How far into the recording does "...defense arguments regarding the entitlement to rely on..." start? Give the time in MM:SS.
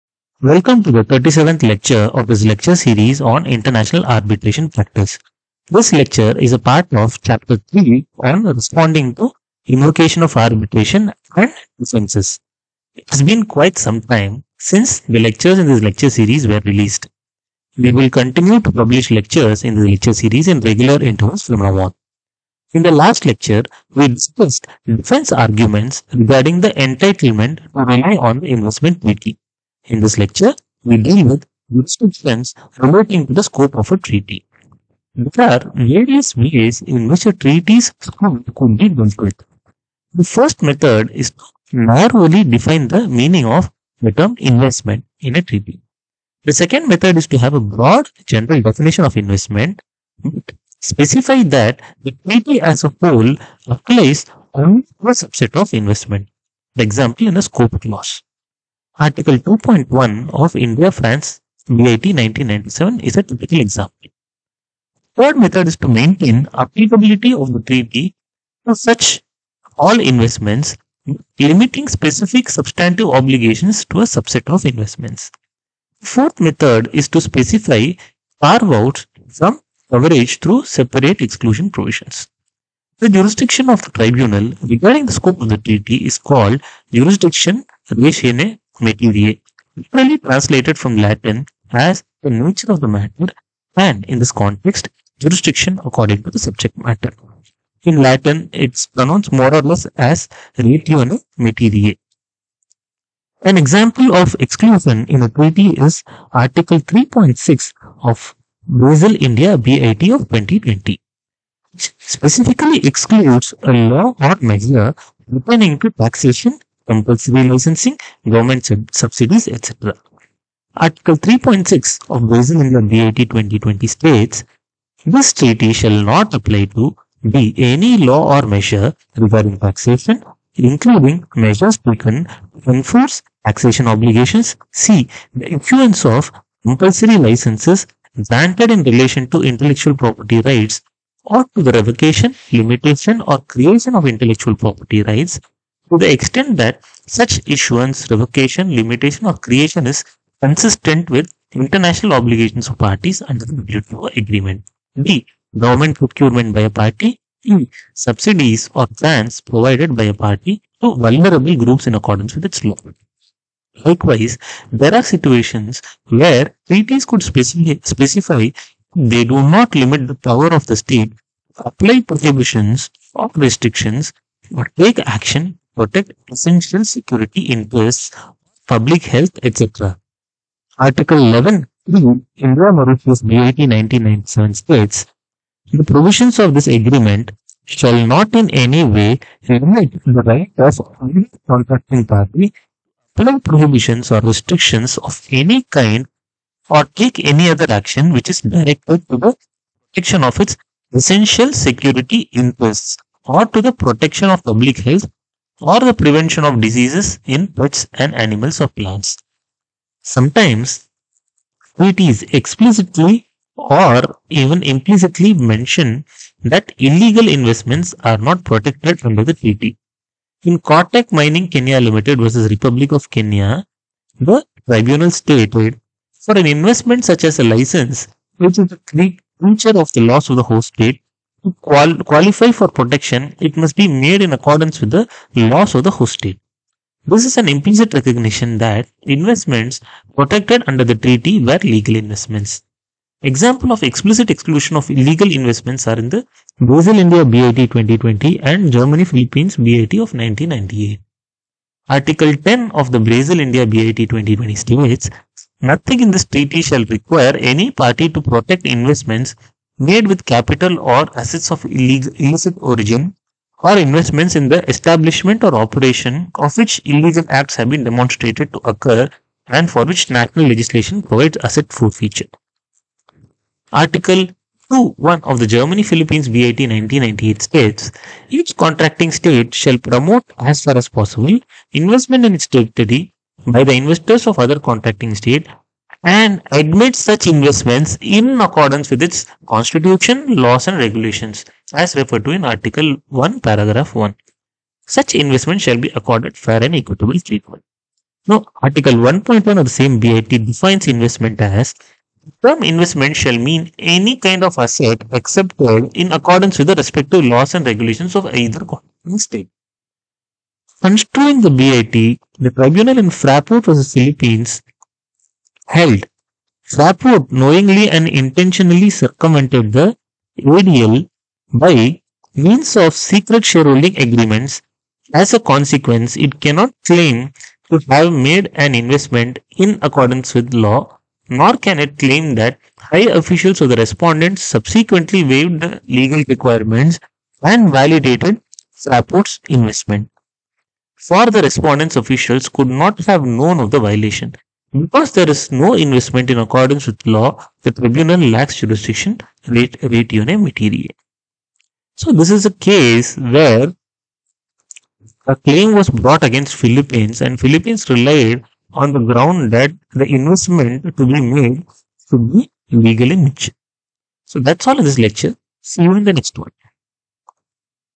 00:24.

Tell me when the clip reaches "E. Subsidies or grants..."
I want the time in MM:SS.
02:37.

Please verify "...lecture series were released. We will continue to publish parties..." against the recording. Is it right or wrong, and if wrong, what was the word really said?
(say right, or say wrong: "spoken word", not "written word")
wrong: "lectures", not "parties".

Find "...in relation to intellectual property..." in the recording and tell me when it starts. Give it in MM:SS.
02:18.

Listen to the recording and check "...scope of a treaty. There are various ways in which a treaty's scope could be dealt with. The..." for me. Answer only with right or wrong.
right.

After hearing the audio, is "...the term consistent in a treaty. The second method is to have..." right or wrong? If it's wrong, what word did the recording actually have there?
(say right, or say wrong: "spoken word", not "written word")
wrong: "investment", not "consistent".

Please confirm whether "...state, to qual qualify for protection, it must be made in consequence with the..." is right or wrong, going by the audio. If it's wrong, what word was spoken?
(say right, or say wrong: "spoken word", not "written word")
wrong: "accordance", not "consequence".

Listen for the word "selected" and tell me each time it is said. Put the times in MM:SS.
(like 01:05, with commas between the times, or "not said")
not said.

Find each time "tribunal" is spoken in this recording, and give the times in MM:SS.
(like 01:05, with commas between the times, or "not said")
01:23, 03:44, 05:12, 05:47.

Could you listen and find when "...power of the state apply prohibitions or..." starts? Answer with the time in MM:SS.
02:50.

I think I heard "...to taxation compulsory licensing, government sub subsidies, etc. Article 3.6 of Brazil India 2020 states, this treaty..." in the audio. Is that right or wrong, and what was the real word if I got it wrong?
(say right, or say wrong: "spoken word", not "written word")
right.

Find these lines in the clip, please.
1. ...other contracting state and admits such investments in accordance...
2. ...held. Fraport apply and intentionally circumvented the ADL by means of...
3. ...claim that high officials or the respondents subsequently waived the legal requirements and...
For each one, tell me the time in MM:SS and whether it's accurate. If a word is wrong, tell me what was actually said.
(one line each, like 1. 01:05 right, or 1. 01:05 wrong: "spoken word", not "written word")
1. 04:44 right
2. 05:15 wrong: "knowingly", not "apply"
3. 05:31 right.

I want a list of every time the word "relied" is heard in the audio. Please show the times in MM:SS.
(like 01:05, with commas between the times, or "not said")
05:57.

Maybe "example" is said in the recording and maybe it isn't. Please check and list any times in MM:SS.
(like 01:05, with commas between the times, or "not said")
00:56, 01:03, 01:43, 04:03.